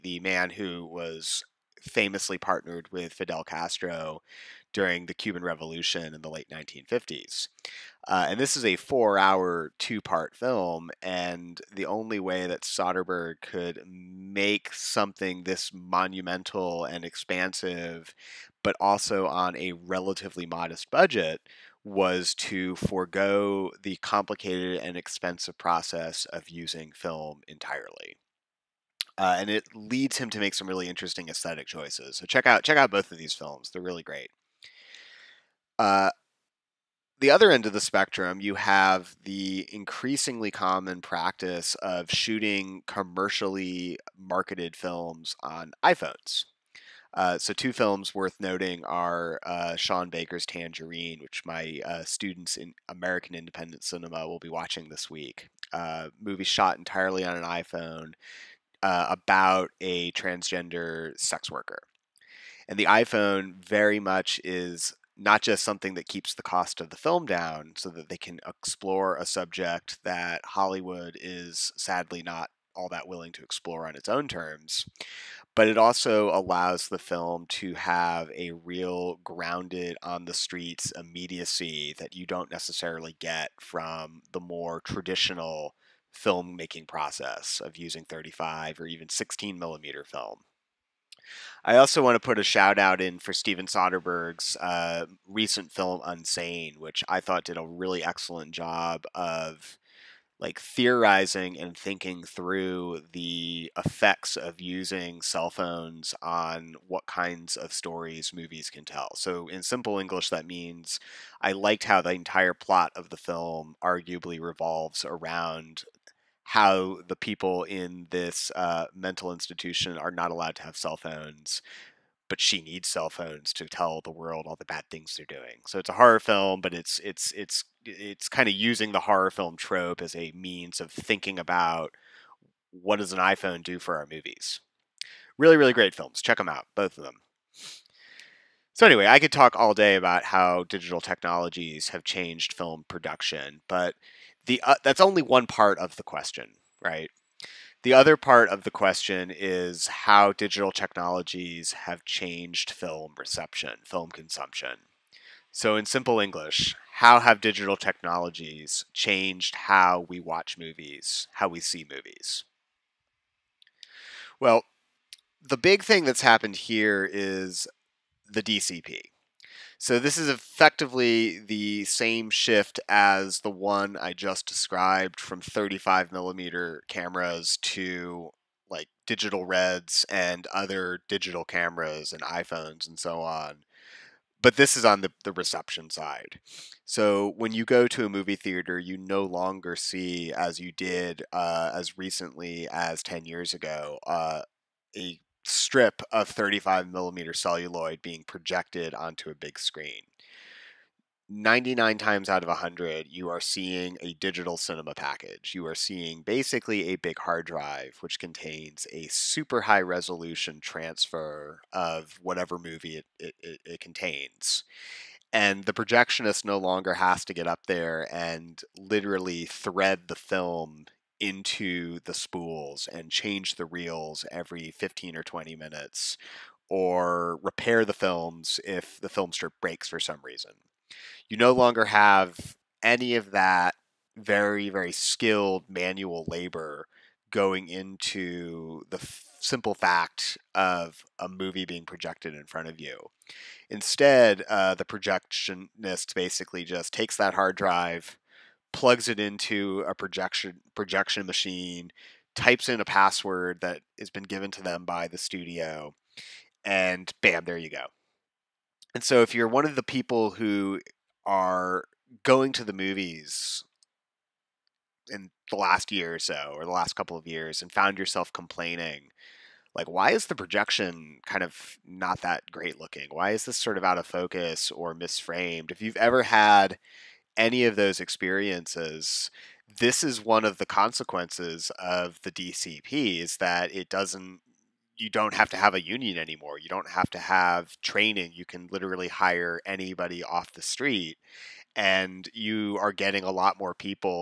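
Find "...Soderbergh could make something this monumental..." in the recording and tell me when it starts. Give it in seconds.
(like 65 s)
12 s.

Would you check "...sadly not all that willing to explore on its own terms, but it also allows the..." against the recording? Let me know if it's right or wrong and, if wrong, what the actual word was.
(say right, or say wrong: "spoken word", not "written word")
right.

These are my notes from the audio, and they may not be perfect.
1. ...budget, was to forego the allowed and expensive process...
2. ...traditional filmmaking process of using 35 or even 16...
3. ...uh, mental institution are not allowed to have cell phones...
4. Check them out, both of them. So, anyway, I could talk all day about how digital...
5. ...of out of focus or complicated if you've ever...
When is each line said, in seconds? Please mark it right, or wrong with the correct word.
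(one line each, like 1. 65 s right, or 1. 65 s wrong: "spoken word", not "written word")
1. 20 s wrong: "complicated", not "allowed"
2. 84 s right
3. 118 s right
4. 136 s right
5. 273 s wrong: "misframed", not "complicated".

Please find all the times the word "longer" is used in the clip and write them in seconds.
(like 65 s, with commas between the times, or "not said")
189 s, 216 s, 231 s.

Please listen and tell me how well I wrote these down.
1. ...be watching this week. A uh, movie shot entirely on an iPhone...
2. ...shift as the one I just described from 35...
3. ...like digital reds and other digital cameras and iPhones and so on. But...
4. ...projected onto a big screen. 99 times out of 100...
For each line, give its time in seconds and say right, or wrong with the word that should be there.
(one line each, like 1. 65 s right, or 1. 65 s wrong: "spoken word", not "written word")
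1. 54 s right
2. 172 s right
3. 178 s right
4. 198 s right.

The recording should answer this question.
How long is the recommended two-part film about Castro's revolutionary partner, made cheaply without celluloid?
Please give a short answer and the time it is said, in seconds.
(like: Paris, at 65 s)
4 hours, at 8 s.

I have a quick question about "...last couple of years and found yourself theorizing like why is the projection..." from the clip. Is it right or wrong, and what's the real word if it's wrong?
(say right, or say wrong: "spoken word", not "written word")
wrong: "complaining", not "theorizing".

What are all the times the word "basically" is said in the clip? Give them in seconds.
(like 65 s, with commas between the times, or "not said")
206 s, 246 s.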